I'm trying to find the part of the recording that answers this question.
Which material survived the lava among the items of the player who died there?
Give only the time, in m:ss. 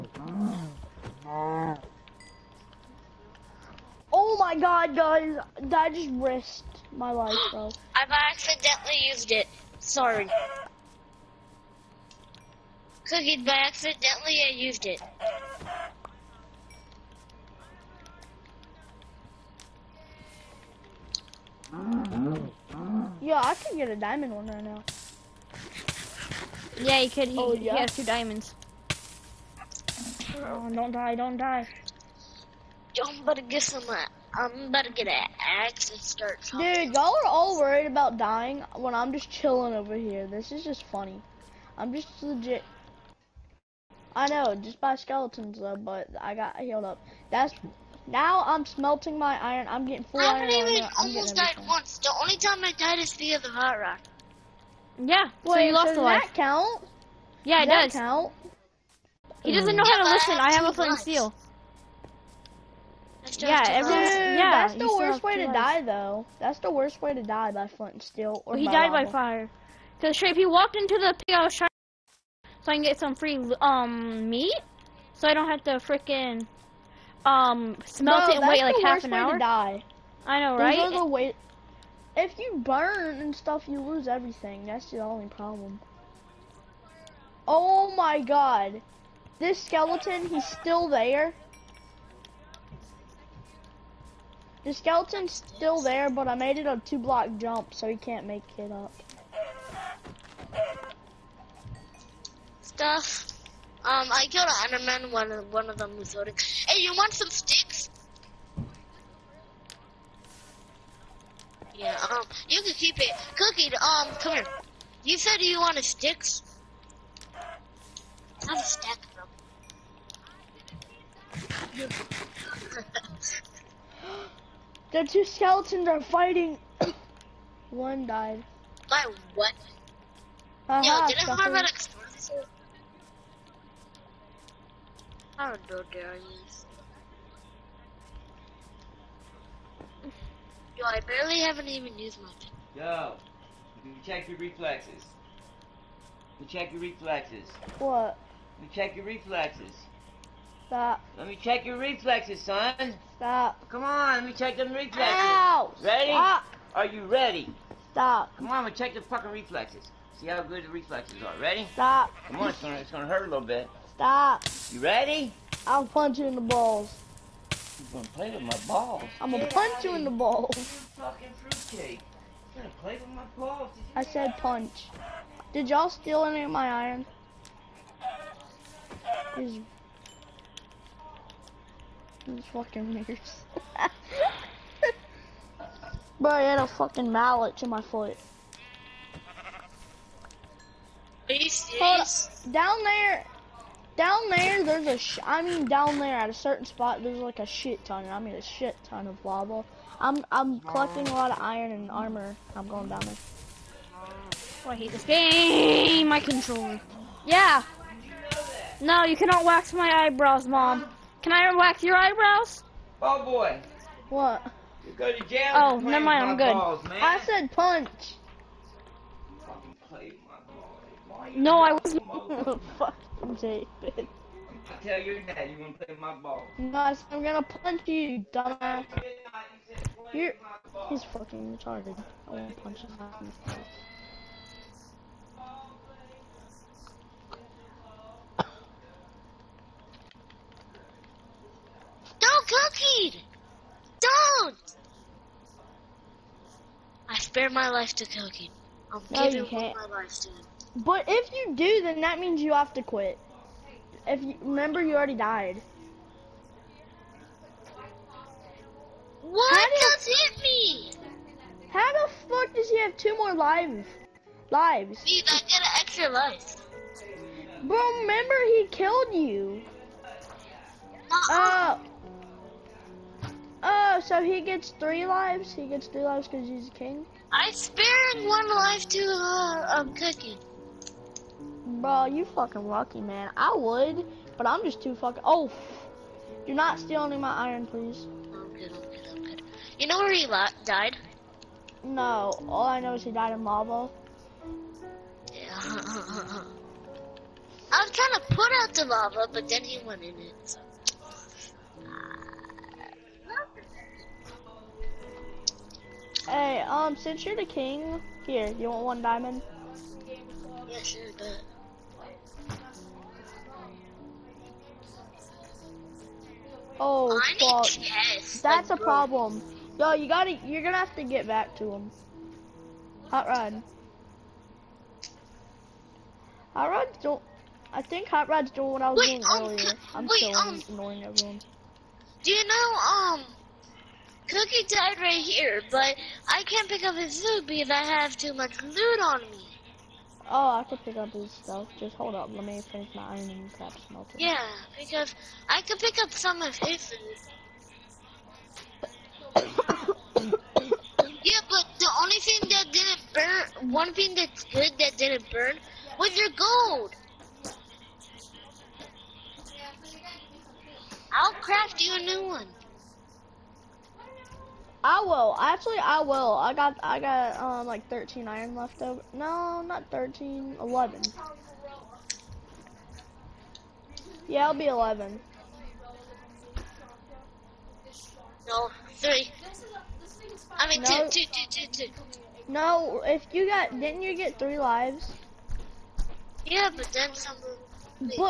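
5:56.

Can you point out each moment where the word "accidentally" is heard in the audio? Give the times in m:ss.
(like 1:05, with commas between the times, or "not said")
0:08, 0:13.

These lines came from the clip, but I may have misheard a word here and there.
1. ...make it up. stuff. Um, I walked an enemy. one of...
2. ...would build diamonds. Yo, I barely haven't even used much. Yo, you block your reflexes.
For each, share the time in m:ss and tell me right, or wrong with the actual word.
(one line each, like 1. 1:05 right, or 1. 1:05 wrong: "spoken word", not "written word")
1. 1:38 wrong: "killed", not "walked"
2. 2:15 wrong: "check", not "block".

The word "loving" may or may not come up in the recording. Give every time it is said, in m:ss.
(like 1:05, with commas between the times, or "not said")
not said.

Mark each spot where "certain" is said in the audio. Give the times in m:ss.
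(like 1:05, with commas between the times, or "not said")
3:16.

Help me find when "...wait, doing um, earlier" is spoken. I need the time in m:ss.
5:28.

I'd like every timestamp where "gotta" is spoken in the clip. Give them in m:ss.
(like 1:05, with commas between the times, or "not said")
5:20.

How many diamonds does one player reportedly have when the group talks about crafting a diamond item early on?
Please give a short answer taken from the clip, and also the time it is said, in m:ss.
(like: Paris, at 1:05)
2, at 0:27.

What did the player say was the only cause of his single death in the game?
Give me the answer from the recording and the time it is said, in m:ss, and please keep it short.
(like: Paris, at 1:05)
The hot rock, at 0:53.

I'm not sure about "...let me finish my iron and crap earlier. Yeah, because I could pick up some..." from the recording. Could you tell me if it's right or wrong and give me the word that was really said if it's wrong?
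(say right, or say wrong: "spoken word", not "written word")
wrong: "smelter", not "earlier".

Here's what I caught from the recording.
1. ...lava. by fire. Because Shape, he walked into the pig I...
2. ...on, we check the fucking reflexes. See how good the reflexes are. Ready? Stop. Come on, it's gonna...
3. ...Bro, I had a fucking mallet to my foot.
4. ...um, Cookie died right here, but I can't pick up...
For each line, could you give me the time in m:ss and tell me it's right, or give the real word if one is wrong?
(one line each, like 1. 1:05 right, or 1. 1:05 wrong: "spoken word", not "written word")
1. 1:08 right
2. 2:38 right
3. 3:06 right
4. 5:32 right.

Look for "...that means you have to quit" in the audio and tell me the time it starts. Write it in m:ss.
4:12.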